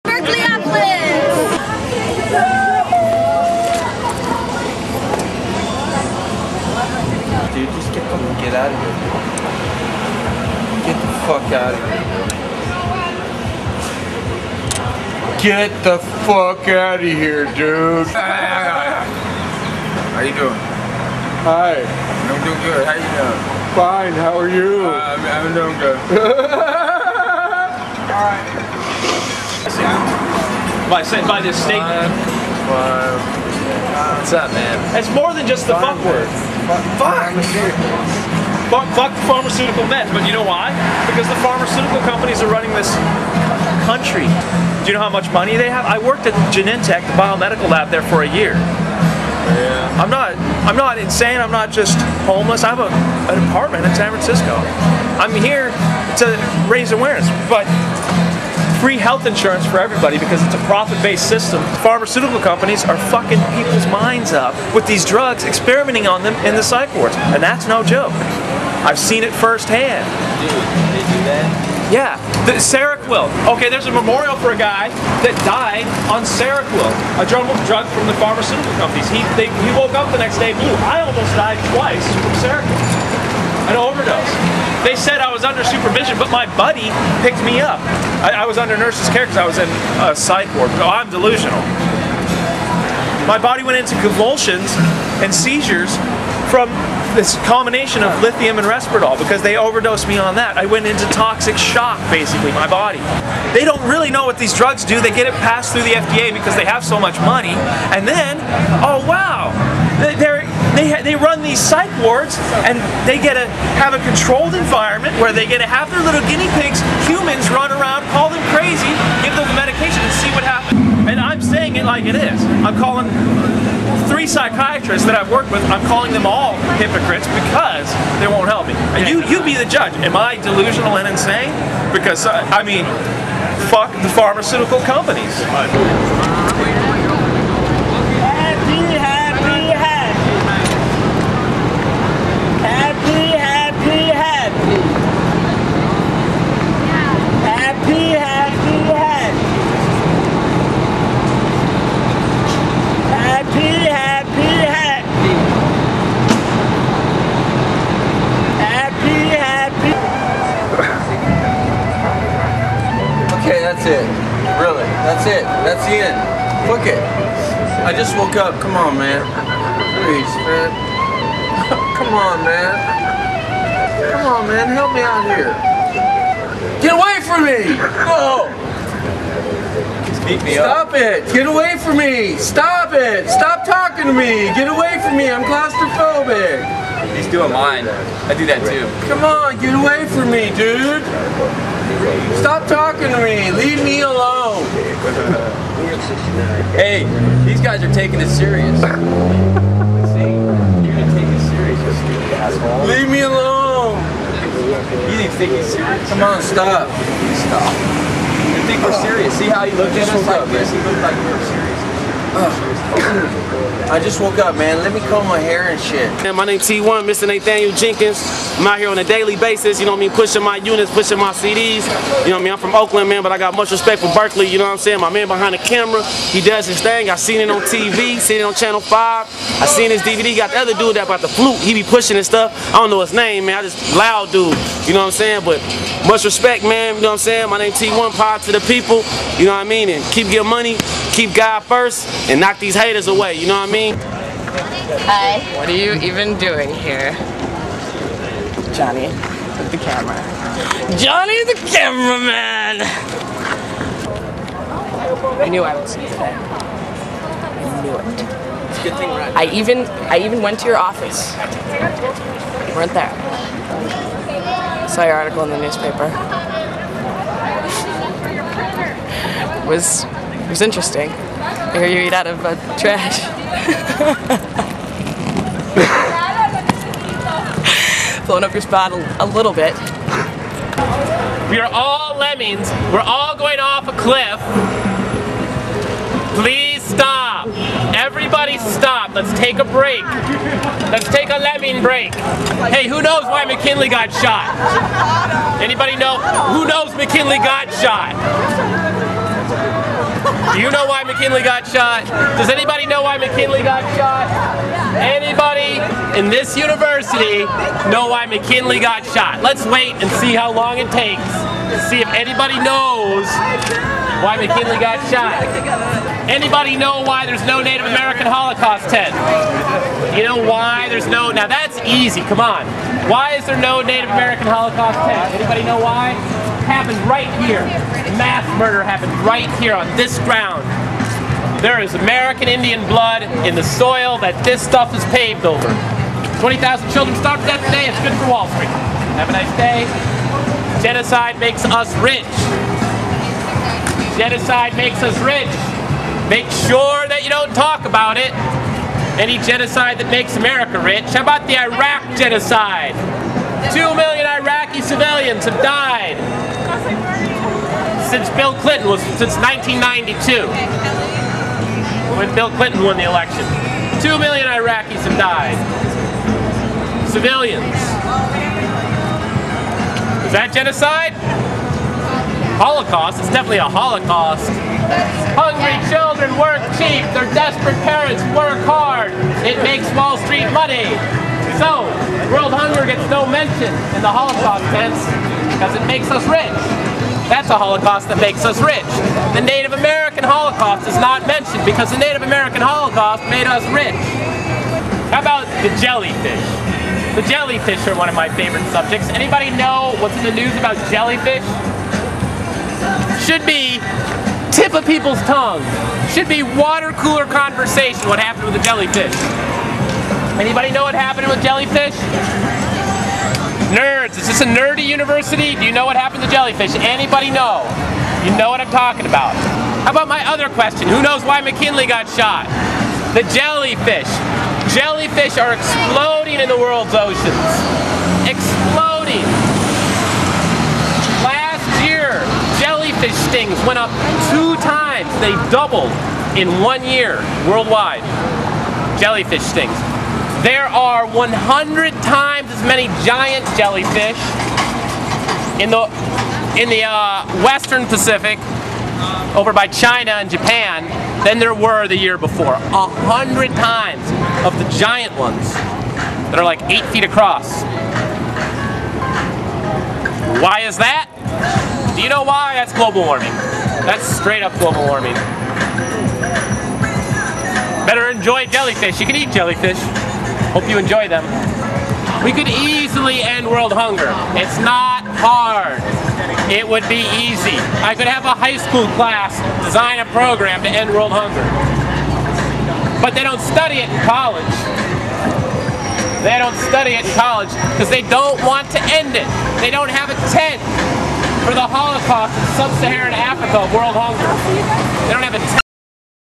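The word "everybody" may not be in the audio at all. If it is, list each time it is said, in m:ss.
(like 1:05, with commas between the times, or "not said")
0:59, 4:47.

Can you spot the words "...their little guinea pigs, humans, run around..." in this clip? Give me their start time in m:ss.
1:55.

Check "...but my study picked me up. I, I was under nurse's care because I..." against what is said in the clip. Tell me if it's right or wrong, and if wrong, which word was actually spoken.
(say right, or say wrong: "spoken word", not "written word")
wrong: "buddy", not "study".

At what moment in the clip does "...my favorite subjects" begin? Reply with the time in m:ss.
6:38.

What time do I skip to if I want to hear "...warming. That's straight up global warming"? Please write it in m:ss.
7:43.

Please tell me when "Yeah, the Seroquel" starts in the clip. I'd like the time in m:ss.
1:11.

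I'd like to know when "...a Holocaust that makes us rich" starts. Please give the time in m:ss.
6:27.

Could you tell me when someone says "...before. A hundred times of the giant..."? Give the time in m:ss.
7:32.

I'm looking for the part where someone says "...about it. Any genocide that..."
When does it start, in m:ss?
5:47.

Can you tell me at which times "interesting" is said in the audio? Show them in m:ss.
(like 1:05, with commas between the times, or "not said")
4:30.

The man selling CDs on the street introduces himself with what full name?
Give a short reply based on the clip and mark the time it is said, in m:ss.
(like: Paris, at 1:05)
Nathaniel Jenkins, at 3:37.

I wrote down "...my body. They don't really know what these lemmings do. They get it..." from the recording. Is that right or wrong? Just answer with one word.
wrong.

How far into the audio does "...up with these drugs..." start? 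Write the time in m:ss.
1:04.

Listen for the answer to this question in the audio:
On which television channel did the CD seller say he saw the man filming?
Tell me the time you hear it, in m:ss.
3:48.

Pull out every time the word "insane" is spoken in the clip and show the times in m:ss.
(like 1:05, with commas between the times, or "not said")
0:50, 2:11.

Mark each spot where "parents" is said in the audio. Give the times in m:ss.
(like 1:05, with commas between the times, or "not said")
6:17.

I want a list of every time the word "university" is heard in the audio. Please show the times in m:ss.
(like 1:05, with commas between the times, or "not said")
5:06, 6:54.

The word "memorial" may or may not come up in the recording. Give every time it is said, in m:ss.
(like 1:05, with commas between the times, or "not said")
1:13.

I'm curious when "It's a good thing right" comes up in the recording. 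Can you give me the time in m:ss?
4:18.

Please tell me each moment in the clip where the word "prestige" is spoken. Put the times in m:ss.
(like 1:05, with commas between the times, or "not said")
not said.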